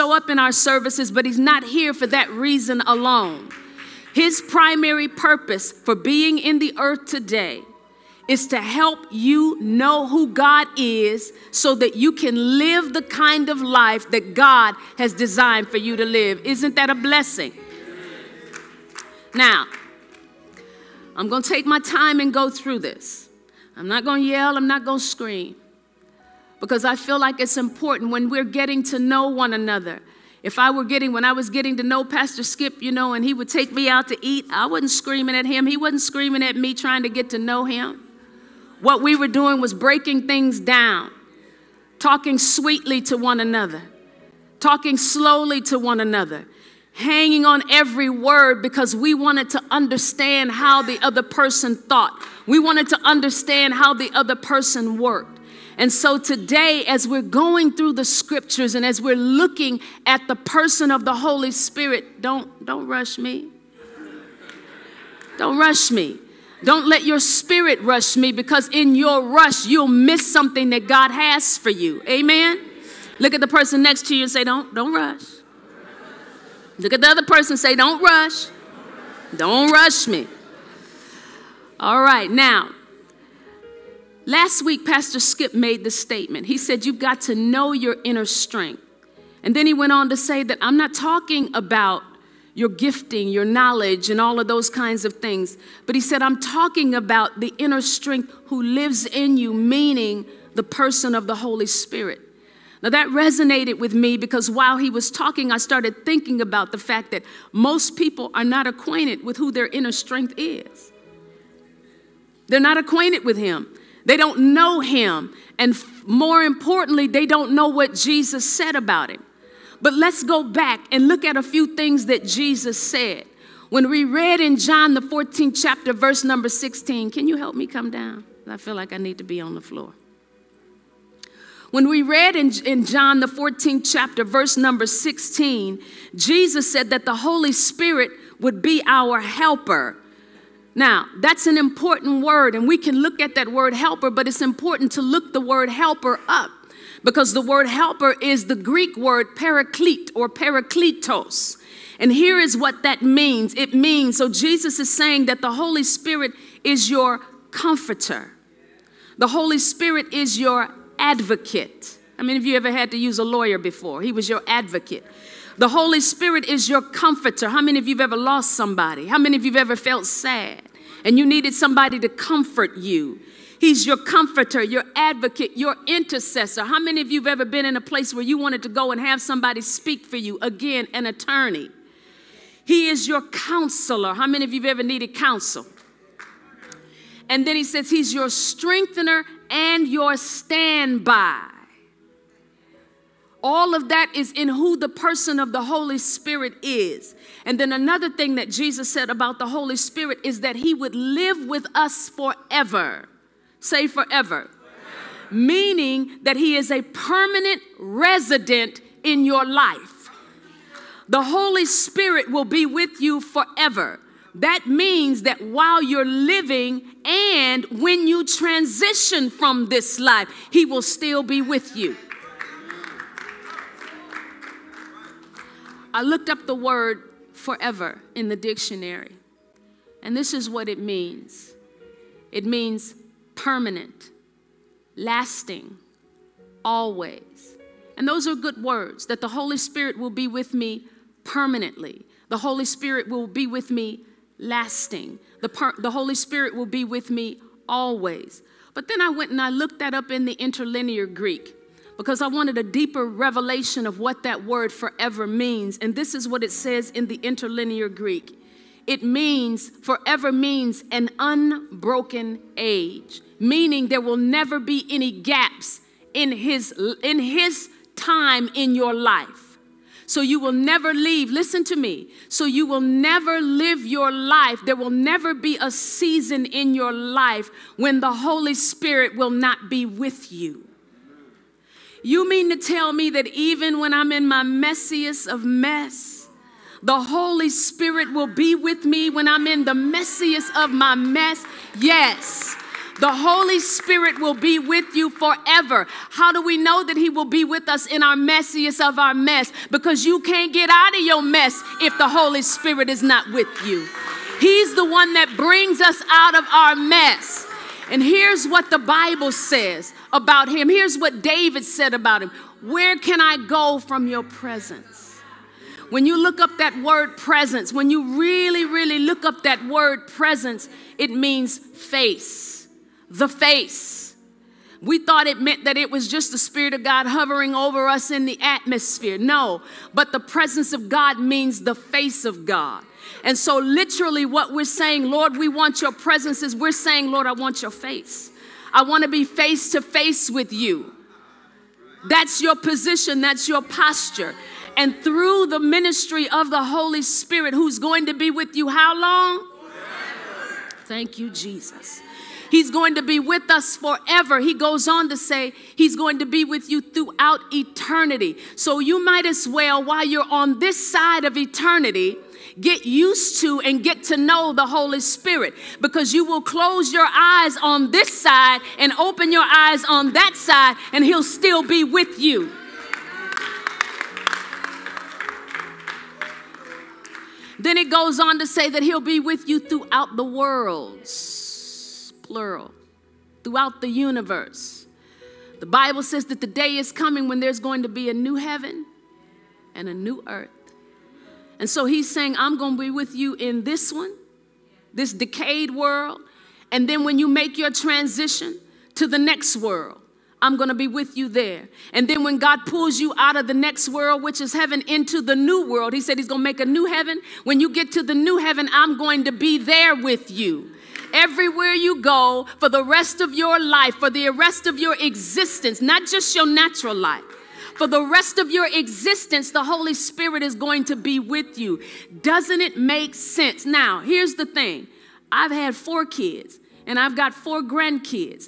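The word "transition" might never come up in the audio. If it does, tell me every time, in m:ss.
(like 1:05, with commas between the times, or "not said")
3:38, 6:37.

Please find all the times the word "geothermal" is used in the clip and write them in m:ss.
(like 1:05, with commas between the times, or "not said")
not said.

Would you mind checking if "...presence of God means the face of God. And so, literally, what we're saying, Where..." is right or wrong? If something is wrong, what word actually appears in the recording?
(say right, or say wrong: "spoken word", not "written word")
wrong: "Lord", not "Where".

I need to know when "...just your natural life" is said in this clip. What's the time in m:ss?
6:56.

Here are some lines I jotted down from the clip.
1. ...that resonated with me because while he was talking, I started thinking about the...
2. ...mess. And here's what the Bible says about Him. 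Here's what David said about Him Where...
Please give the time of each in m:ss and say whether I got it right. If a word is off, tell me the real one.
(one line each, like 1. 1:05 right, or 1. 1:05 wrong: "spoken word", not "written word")
1. 1:42 right
2. 5:06 right.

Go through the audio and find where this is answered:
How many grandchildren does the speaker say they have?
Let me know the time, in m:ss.
7:07.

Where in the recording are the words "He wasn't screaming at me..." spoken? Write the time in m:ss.
0:35.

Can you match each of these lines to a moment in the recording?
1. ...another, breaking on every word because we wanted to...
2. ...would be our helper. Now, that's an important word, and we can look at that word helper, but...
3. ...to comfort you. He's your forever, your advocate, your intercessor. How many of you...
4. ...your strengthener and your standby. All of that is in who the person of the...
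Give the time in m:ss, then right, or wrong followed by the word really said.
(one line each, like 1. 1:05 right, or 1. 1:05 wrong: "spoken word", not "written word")
1. 0:45 wrong: "hanging", not "breaking"
2. 2:18 right
3. 2:52 wrong: "comforter", not "forever"
4. 3:08 right.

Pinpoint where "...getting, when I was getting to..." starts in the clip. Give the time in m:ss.
0:30.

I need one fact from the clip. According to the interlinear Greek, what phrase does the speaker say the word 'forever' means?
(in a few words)
an unbroken age.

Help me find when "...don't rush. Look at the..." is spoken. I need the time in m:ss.
1:14.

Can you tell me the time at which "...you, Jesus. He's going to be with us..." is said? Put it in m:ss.
5:51.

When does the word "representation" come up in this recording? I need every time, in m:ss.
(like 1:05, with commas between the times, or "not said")
not said.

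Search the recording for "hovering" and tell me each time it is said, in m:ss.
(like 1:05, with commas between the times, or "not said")
5:27.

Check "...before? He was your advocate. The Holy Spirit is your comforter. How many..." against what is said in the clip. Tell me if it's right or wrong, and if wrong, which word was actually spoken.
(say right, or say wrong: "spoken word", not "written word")
right.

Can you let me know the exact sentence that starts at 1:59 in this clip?
But let's go back and look at a few things that Jesus said.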